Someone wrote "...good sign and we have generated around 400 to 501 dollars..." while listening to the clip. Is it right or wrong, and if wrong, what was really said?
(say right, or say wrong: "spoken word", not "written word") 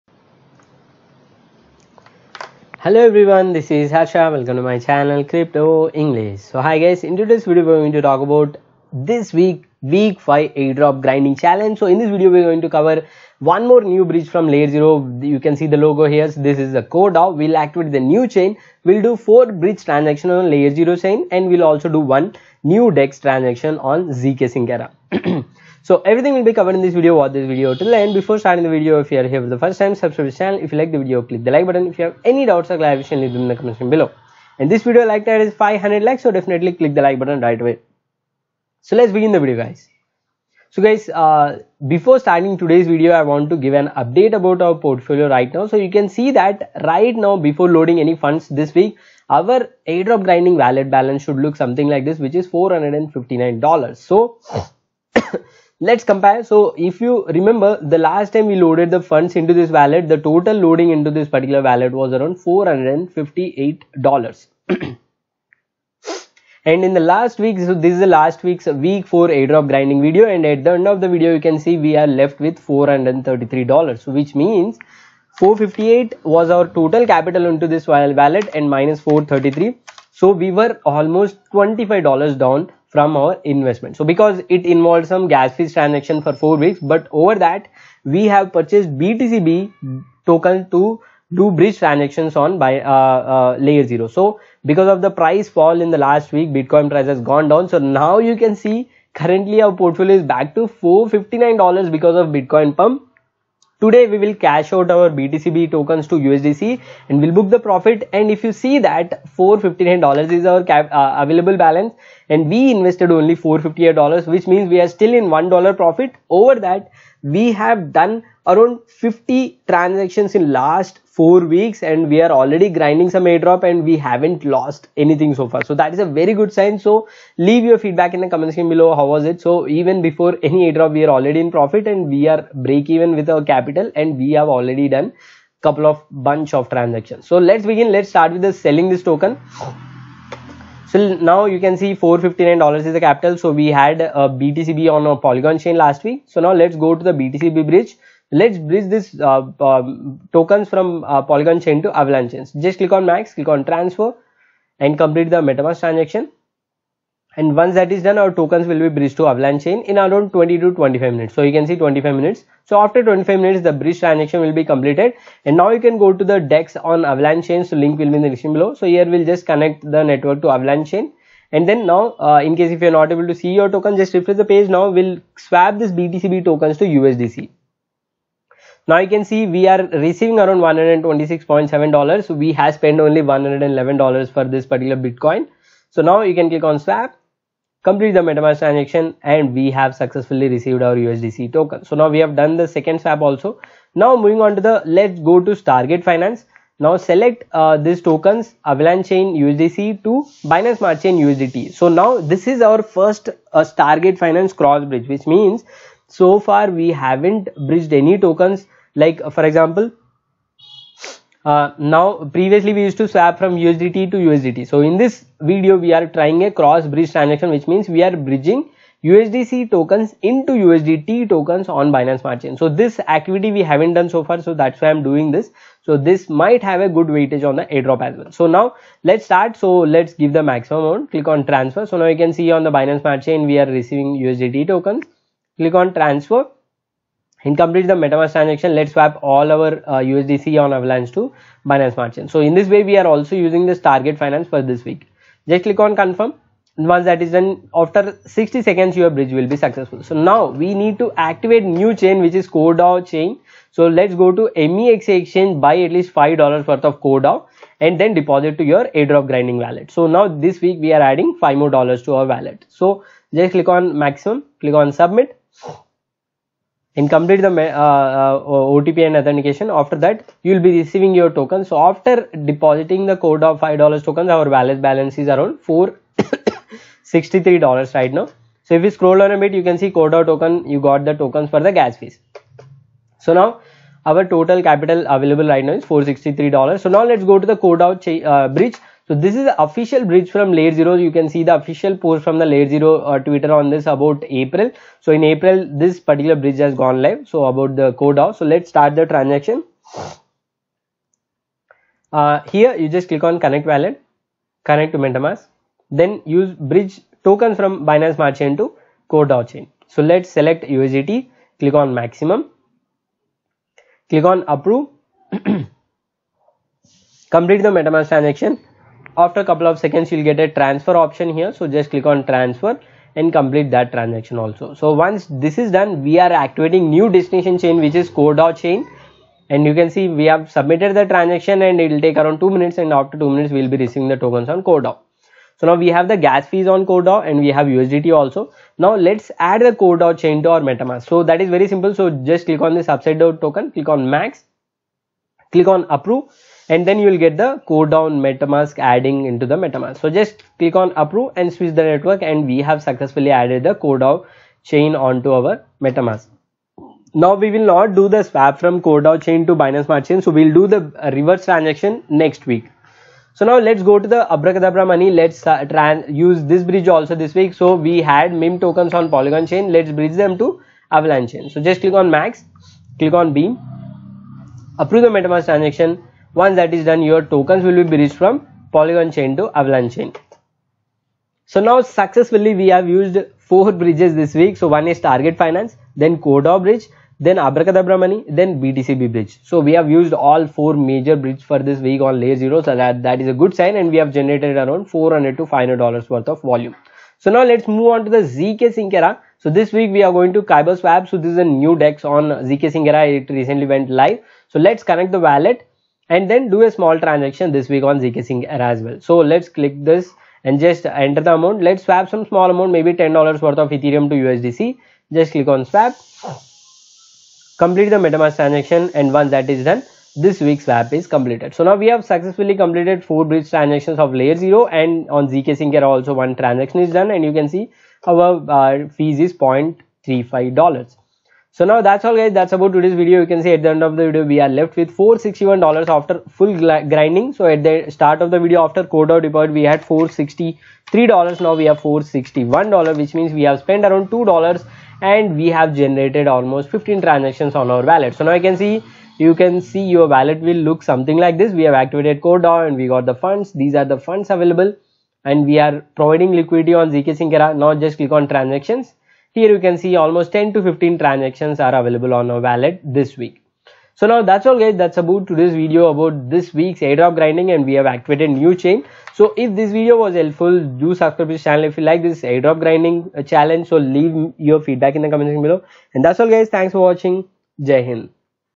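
wrong: "500", not "501".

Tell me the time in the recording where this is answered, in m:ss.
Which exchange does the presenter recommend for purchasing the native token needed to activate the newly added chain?
4:14.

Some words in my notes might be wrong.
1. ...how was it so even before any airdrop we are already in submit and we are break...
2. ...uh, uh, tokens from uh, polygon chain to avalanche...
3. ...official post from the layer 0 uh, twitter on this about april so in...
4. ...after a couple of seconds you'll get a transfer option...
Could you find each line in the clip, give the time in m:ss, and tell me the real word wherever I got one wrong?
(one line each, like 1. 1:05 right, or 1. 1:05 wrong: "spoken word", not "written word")
1. 2:08 wrong: "profit", not "submit"
2. 2:29 right
3. 4:51 right
4. 5:19 right.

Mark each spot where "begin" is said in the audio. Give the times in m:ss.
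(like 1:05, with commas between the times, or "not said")
0:39, 2:17.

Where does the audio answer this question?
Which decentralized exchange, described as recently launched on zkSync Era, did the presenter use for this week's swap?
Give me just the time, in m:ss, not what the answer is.
6:40.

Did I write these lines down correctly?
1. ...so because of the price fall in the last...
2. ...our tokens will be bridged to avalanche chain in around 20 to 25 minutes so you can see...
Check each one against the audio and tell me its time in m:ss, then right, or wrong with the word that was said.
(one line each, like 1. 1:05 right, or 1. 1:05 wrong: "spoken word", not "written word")
1. 1:34 right
2. 2:38 right.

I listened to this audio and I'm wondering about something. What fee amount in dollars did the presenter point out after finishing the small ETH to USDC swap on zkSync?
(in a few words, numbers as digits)
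$0.35.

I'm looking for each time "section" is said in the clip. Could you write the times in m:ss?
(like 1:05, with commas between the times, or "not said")
0:33, 2:08, 7:55.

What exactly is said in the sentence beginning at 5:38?
Now let's add the CoreDAO chain to our MetaMask.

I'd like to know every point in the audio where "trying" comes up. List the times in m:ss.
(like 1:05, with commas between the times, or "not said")
3:36.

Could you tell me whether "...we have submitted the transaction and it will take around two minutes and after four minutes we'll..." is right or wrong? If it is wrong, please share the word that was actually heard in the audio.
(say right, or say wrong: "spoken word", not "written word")
wrong: "two", not "four".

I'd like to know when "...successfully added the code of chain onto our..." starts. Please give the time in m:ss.
5:52.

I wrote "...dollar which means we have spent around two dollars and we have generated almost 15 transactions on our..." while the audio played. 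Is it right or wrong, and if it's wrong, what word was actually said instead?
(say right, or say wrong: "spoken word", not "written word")
right.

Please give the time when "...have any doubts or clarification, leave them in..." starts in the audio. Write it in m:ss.
0:32.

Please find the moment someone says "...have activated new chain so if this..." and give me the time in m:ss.
7:47.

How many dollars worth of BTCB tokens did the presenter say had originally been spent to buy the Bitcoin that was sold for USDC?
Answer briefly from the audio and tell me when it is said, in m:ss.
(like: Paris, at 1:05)
$111, at 3:03.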